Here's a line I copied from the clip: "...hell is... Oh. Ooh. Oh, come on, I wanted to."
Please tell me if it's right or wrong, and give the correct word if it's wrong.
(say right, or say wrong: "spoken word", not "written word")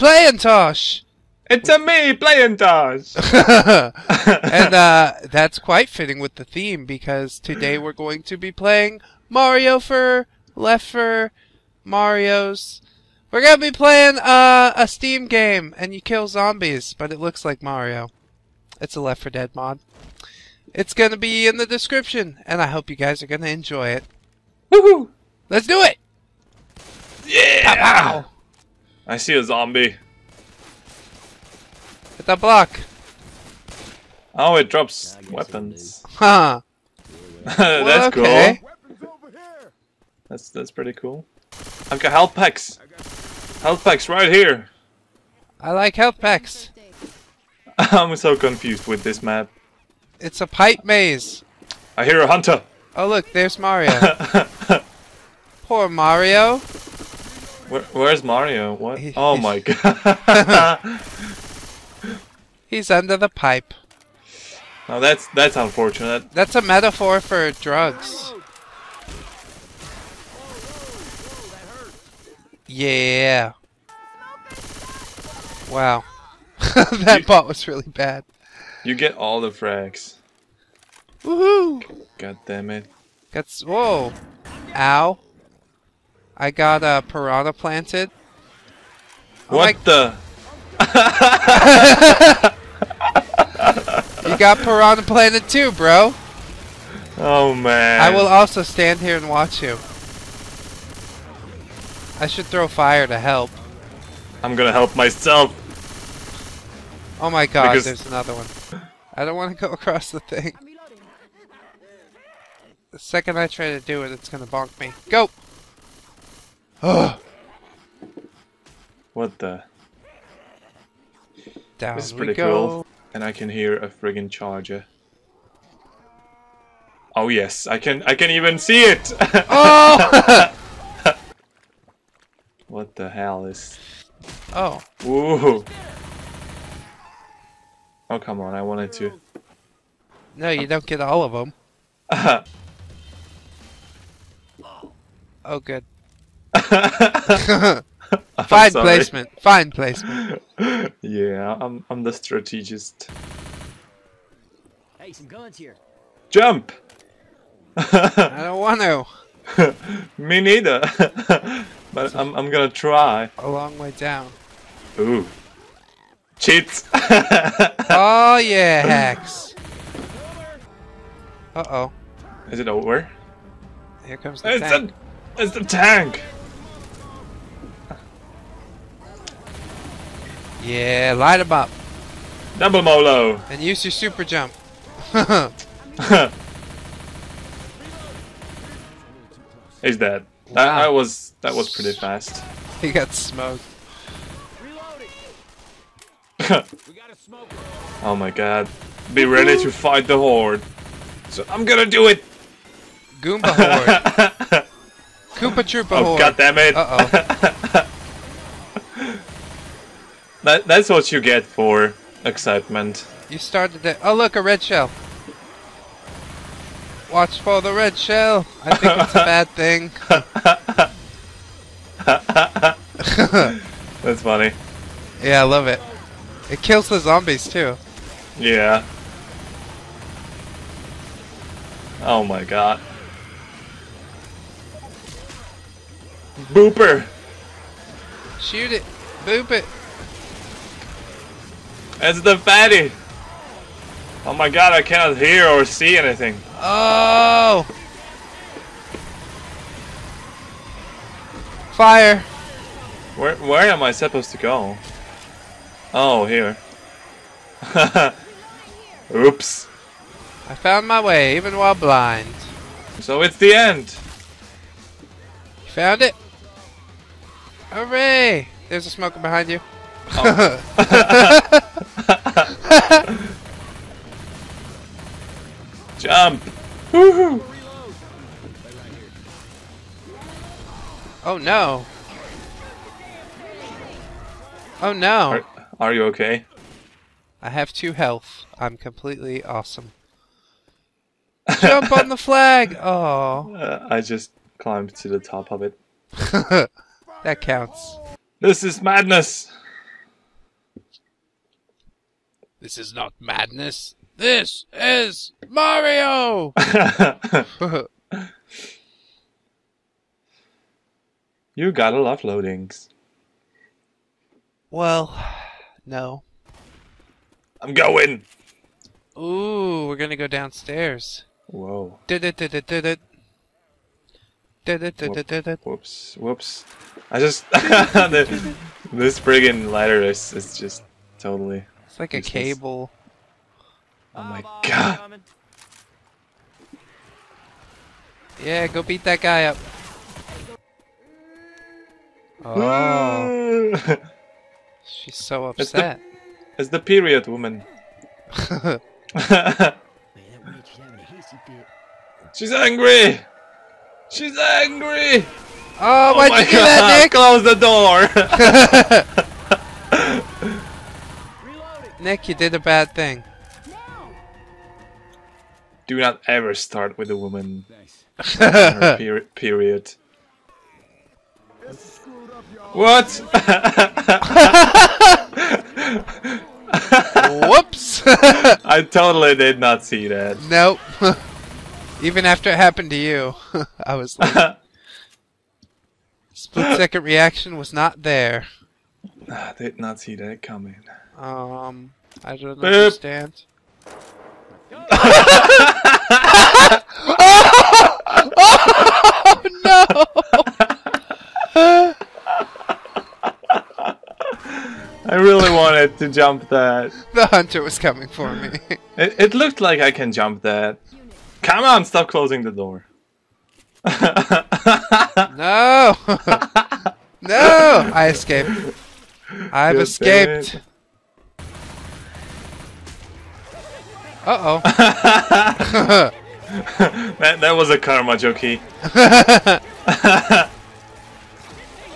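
right.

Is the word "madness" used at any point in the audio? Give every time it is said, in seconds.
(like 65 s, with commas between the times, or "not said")
298 s, 303 s.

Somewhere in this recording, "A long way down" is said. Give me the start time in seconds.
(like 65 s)
163 s.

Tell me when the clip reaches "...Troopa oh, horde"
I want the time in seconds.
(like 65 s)
205 s.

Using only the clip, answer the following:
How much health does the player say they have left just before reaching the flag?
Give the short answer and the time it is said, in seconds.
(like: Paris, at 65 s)
2, at 287 s.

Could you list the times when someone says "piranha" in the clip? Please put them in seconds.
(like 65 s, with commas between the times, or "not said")
87 s, 94 s.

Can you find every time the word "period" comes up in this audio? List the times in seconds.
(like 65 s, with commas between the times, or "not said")
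346 s, 369 s.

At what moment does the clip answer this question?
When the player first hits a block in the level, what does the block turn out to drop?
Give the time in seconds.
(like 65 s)
35 s.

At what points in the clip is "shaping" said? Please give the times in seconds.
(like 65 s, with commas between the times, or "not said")
not said.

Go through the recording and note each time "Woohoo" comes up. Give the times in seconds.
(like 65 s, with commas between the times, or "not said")
24 s, 81 s, 276 s.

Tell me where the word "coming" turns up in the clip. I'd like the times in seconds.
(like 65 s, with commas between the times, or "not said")
390 s, 407 s.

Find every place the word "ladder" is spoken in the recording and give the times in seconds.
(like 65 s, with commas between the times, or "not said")
329 s.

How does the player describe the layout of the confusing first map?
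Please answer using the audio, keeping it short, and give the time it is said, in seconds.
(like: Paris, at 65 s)
A pipe maze, at 50 s.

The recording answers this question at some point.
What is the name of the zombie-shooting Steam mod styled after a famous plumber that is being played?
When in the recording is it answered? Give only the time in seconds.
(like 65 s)
10 s.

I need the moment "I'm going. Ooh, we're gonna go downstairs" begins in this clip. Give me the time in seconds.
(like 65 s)
317 s.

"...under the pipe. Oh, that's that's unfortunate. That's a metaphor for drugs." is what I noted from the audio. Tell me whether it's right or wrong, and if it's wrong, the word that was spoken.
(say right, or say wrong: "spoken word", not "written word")
right.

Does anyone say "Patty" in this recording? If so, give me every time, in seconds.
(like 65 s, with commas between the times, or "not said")
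not said.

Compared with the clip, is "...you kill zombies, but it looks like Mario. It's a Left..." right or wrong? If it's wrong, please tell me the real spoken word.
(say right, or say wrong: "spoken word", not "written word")
right.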